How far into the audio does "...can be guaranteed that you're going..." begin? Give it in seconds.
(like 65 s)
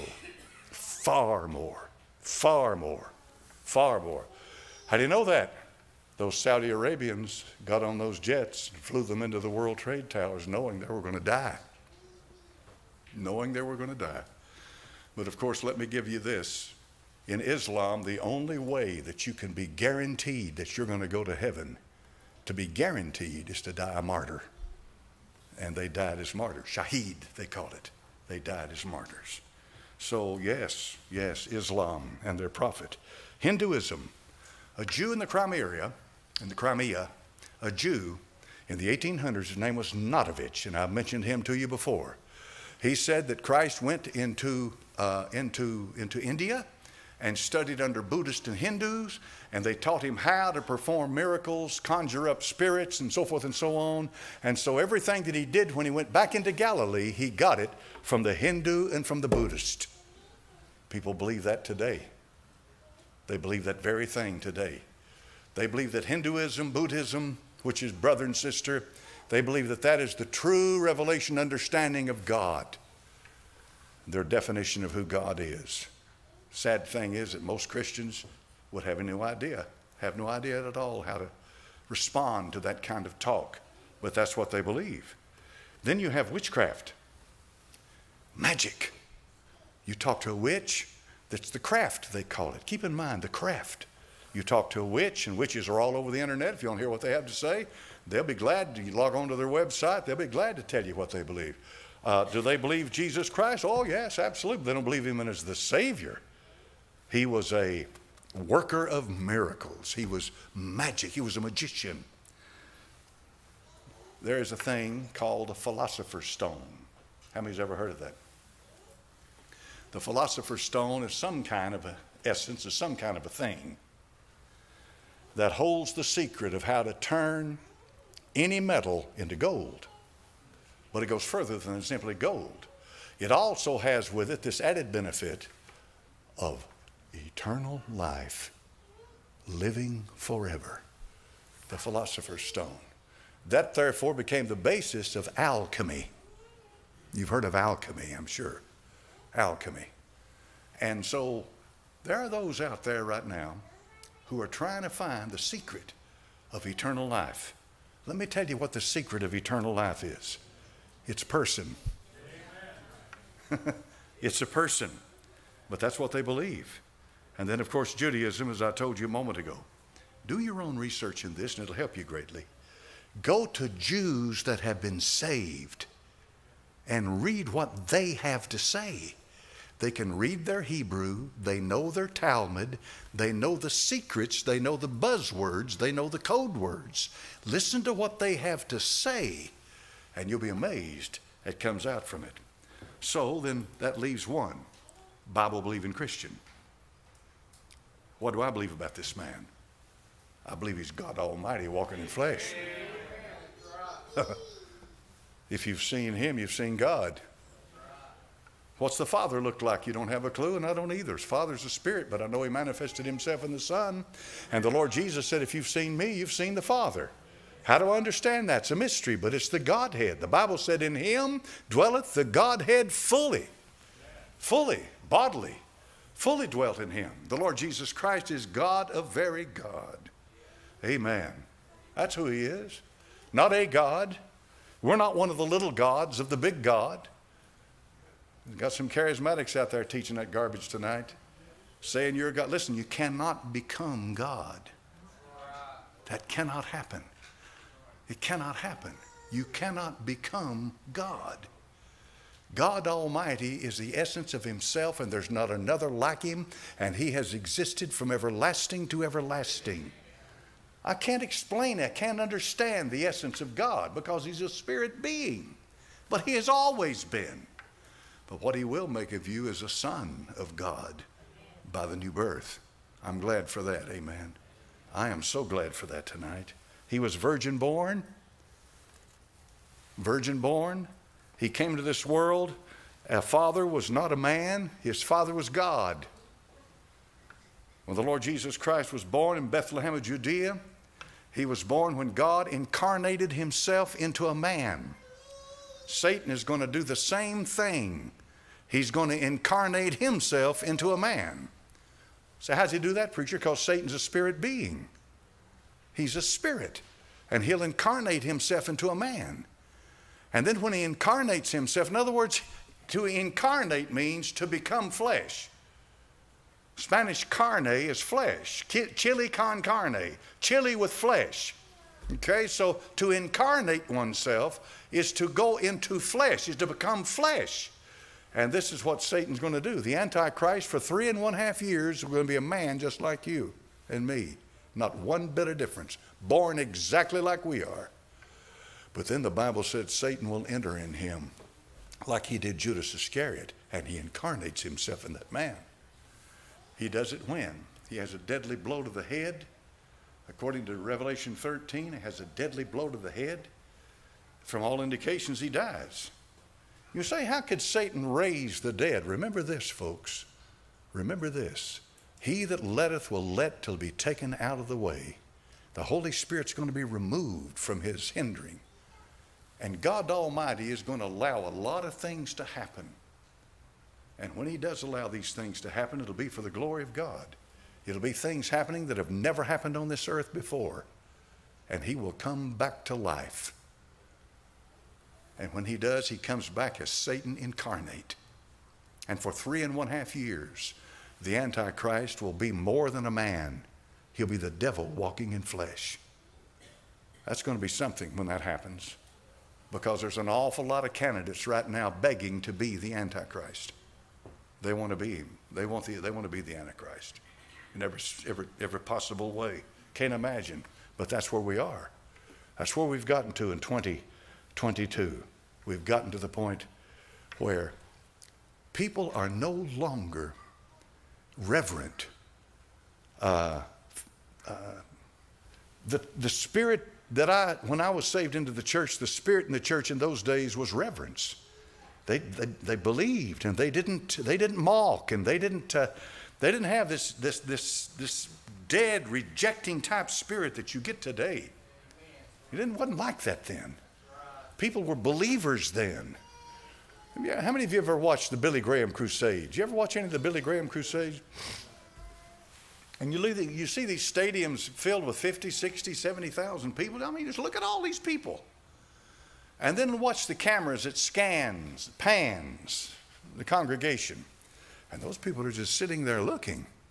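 19 s.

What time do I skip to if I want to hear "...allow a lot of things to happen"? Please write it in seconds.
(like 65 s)
371 s.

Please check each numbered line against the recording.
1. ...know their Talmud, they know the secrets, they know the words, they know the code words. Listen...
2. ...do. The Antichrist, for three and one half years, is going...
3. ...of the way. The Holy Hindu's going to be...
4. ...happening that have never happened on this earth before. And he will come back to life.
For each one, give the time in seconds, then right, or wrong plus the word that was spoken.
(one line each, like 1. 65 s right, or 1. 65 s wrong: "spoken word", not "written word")
1. 181 s wrong: "buzzwords", not "words"
2. 329 s right
3. 364 s wrong: "Spirit", not "Hindu"
4. 378 s right.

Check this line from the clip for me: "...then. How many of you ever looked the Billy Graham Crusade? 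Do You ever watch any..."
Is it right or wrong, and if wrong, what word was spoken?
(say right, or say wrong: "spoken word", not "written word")
wrong: "watched", not "looked".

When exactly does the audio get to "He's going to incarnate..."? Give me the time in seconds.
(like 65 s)
298 s.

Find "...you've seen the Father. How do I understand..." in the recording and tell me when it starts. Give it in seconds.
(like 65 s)
216 s.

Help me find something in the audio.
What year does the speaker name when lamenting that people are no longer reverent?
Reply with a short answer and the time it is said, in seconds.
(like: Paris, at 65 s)
2022, at 413 s.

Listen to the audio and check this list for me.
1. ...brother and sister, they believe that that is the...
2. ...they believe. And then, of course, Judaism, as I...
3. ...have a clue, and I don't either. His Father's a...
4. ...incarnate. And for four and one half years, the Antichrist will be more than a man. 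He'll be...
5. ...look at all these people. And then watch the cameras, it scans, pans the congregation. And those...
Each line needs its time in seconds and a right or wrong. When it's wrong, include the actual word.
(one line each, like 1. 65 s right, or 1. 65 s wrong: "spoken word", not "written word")
1. 67 s right
2. 166 s right
3. 210 s right
4. 387 s wrong: "three", not "four"
5. 457 s right.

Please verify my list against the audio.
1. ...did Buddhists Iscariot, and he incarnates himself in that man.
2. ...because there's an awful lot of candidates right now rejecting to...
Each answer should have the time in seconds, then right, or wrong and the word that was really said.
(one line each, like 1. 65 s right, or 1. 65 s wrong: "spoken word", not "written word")
1. 342 s wrong: "Judas", not "Buddhists"
2. 399 s wrong: "begging", not "rejecting".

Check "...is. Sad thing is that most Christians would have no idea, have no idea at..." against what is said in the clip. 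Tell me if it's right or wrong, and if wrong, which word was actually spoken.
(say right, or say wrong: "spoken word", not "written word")
right.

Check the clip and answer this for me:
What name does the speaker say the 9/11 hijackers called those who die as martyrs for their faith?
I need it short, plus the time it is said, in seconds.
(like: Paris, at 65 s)
Shaheed, at 26 s.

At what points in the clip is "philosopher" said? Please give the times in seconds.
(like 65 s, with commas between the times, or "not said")
115 s, 119 s, 141 s.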